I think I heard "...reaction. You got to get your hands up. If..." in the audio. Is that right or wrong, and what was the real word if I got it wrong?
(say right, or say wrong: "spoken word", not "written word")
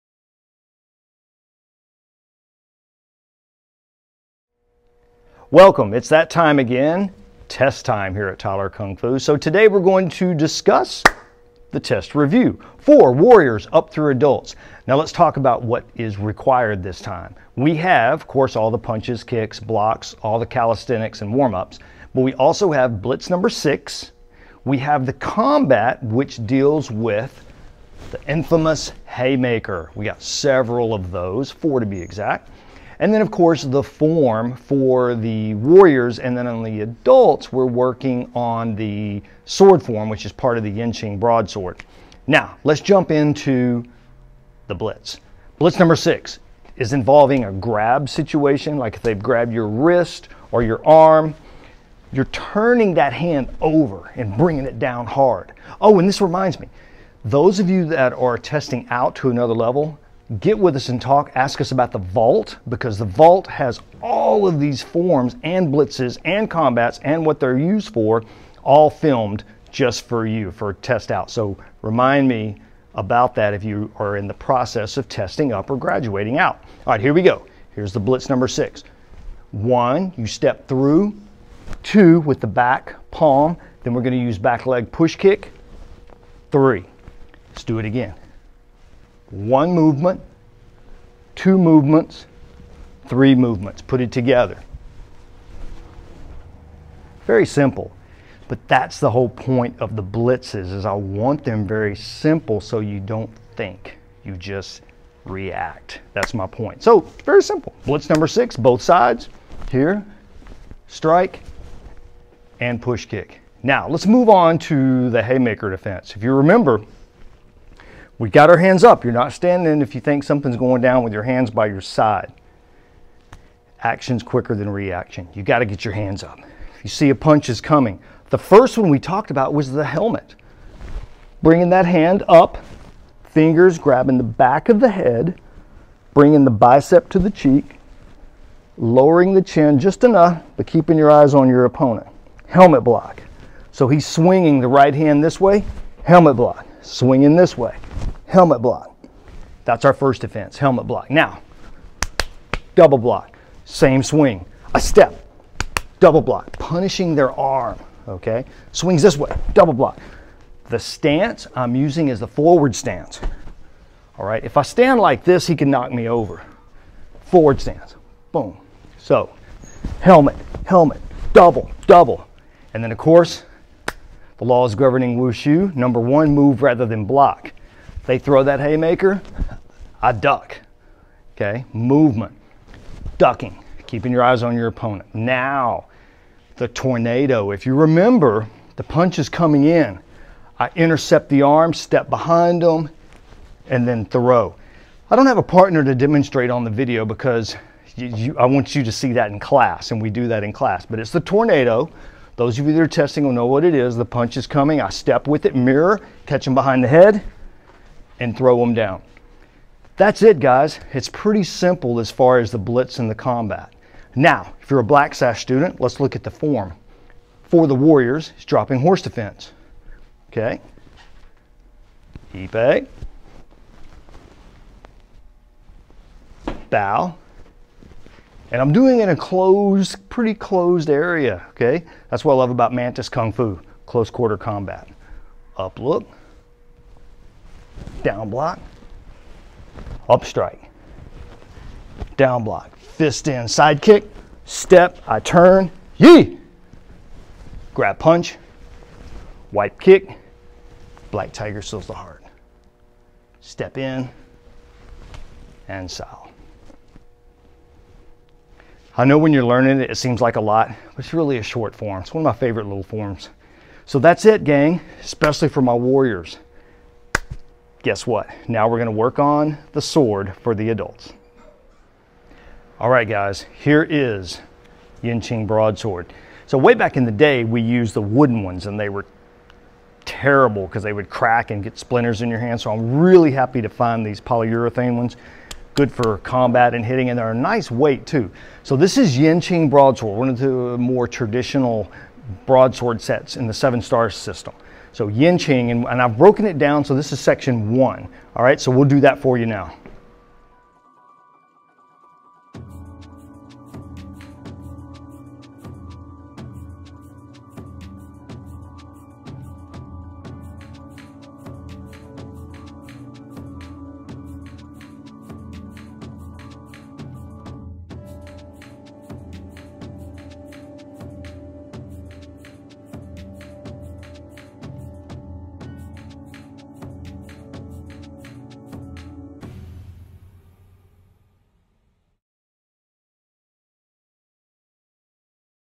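right.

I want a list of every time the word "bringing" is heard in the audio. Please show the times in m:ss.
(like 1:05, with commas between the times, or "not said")
0:54, 2:11, 2:16.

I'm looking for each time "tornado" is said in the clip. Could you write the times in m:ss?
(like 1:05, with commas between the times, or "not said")
3:06, 3:21.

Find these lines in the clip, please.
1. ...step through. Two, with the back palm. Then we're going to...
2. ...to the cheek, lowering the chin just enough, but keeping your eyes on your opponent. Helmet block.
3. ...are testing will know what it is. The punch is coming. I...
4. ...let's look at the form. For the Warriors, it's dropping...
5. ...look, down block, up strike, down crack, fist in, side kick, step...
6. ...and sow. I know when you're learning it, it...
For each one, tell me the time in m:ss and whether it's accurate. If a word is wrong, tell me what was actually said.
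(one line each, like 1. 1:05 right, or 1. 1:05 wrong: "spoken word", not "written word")
1. 1:20 right
2. 2:17 right
3. 3:22 right
4. 3:35 right
5. 3:55 wrong: "block", not "crack"
6. 4:15 right.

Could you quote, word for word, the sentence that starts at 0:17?
We have, of course, all the punches, kicks, blocks, all the calisthenics and warm-ups, but we also have blitz number six.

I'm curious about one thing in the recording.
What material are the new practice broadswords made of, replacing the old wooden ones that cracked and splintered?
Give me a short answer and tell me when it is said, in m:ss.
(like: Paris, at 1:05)
Polyurethane, at 4:44.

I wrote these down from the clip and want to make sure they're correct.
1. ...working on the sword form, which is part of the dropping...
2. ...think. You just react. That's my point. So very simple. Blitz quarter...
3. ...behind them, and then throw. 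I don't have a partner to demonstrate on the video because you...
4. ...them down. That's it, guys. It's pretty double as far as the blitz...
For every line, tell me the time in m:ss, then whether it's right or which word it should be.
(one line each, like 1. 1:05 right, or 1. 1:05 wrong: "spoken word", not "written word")
1. 0:37 wrong: "yinqing", not "dropping"
2. 1:43 wrong: "number", not "quarter"
3. 3:12 right
4. 3:28 wrong: "simple", not "double".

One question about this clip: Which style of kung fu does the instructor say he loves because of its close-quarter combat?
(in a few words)
Mantis Kung Fu.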